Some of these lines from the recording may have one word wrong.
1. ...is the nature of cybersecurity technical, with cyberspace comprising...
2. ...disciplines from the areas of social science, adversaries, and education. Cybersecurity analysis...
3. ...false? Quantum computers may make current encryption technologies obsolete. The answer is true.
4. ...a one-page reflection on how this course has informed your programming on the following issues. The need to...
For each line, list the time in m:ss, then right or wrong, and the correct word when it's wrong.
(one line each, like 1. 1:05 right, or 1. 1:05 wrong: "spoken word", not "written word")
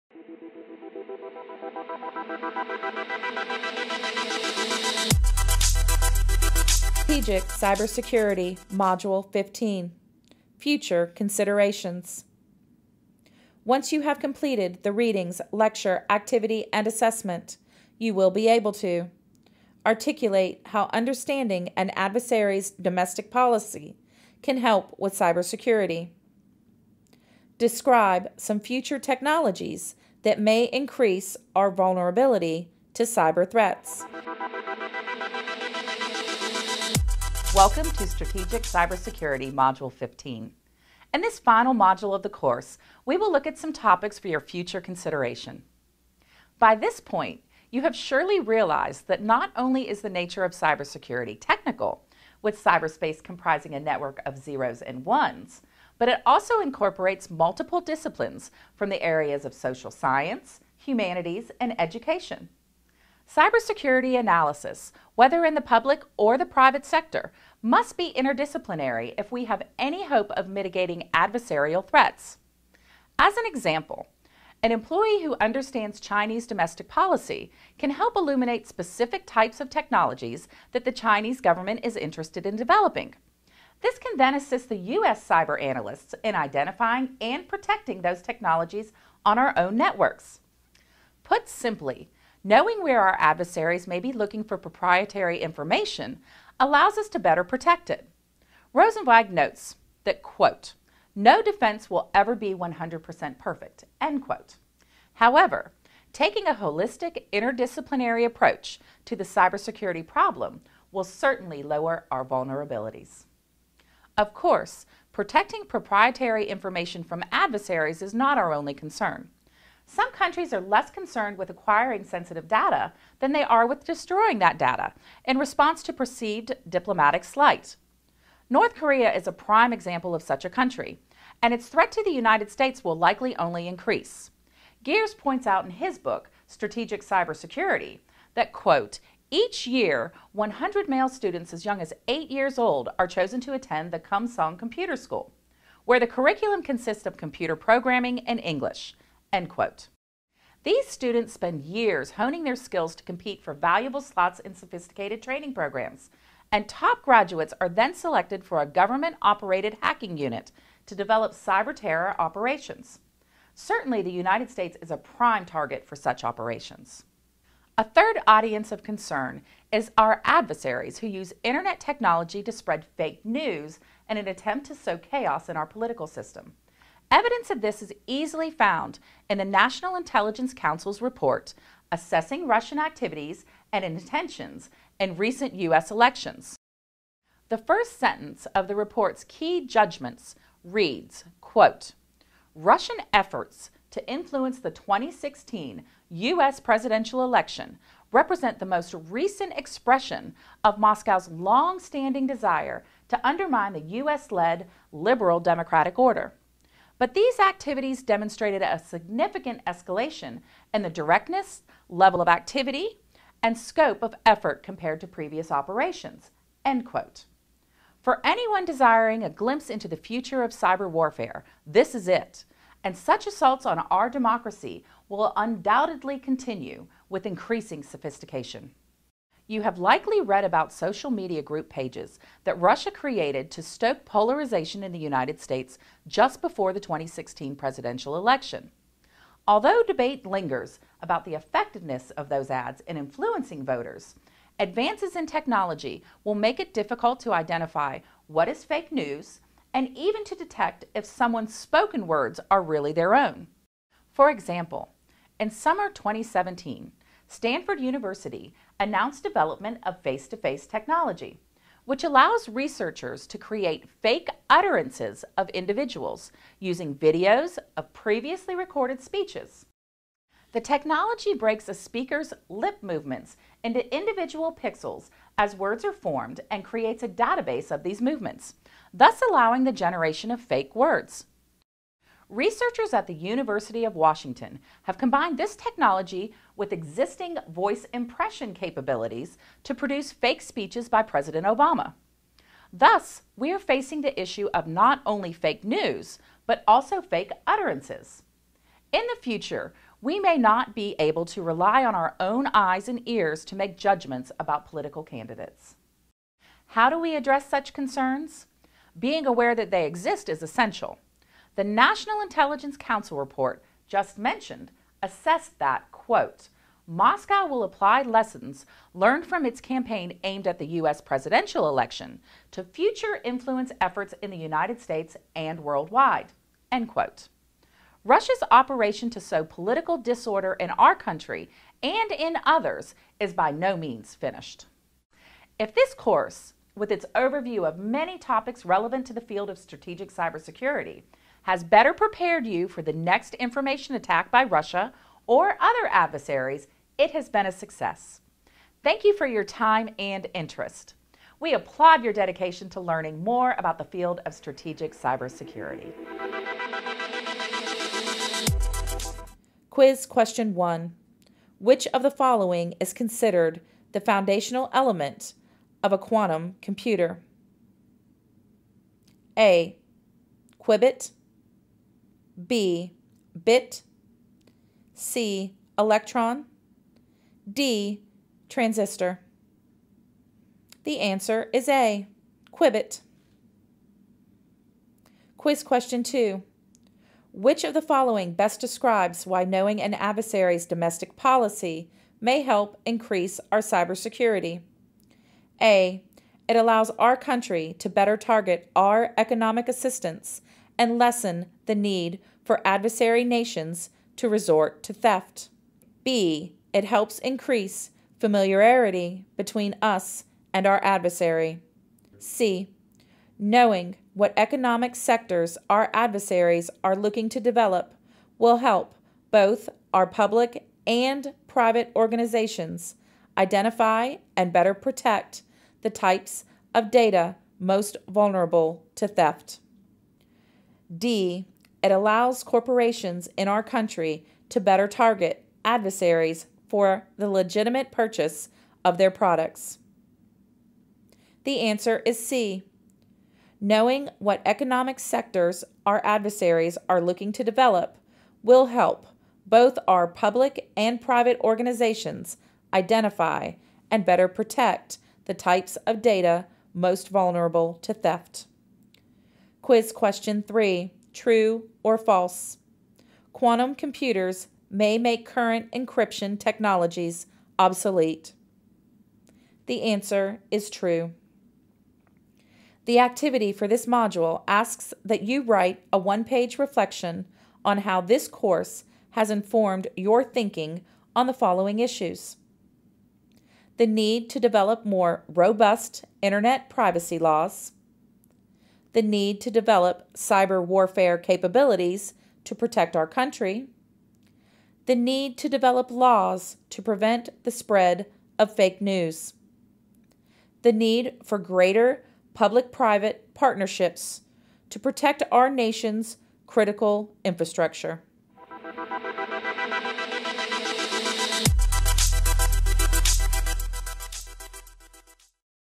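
1. 0:49 right
2. 0:57 wrong: "humanities", not "adversaries"
3. 7:41 right
4. 7:55 wrong: "thinking", not "programming".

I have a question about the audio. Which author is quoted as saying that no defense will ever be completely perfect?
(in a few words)
Rosenzweig.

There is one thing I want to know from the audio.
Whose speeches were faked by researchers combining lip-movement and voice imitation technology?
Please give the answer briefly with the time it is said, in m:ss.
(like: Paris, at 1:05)
President Obama, at 4:51.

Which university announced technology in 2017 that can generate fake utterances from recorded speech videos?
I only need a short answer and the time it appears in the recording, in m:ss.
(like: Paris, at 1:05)
Stanford University, at 4:17.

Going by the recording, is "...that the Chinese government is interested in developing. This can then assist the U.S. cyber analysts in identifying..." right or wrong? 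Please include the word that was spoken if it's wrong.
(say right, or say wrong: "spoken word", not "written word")
right.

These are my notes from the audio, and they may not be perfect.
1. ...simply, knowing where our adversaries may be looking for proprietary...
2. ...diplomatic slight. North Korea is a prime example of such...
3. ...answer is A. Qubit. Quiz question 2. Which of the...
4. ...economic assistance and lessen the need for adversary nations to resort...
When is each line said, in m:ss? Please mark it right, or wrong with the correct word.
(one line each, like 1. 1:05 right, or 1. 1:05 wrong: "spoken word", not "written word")
1. 1:31 right
2. 2:06 right
3. 6:20 right
4. 6:39 right.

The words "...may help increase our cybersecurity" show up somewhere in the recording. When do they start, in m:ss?
6:32.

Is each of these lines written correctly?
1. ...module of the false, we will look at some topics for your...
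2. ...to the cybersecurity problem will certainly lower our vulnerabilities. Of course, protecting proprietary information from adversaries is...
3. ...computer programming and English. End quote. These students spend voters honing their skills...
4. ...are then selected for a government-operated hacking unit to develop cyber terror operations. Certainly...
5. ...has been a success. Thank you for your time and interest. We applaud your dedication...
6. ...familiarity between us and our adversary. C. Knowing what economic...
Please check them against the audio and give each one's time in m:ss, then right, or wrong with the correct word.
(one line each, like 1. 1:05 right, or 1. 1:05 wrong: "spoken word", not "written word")
1. 0:41 wrong: "course", not "false"
2. 1:49 right
3. 2:27 wrong: "years", not "voters"
4. 2:37 right
5. 5:47 right
6. 6:48 right.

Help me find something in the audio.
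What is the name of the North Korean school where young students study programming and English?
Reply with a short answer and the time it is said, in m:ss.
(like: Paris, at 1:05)
Kumsong Computer School, at 2:23.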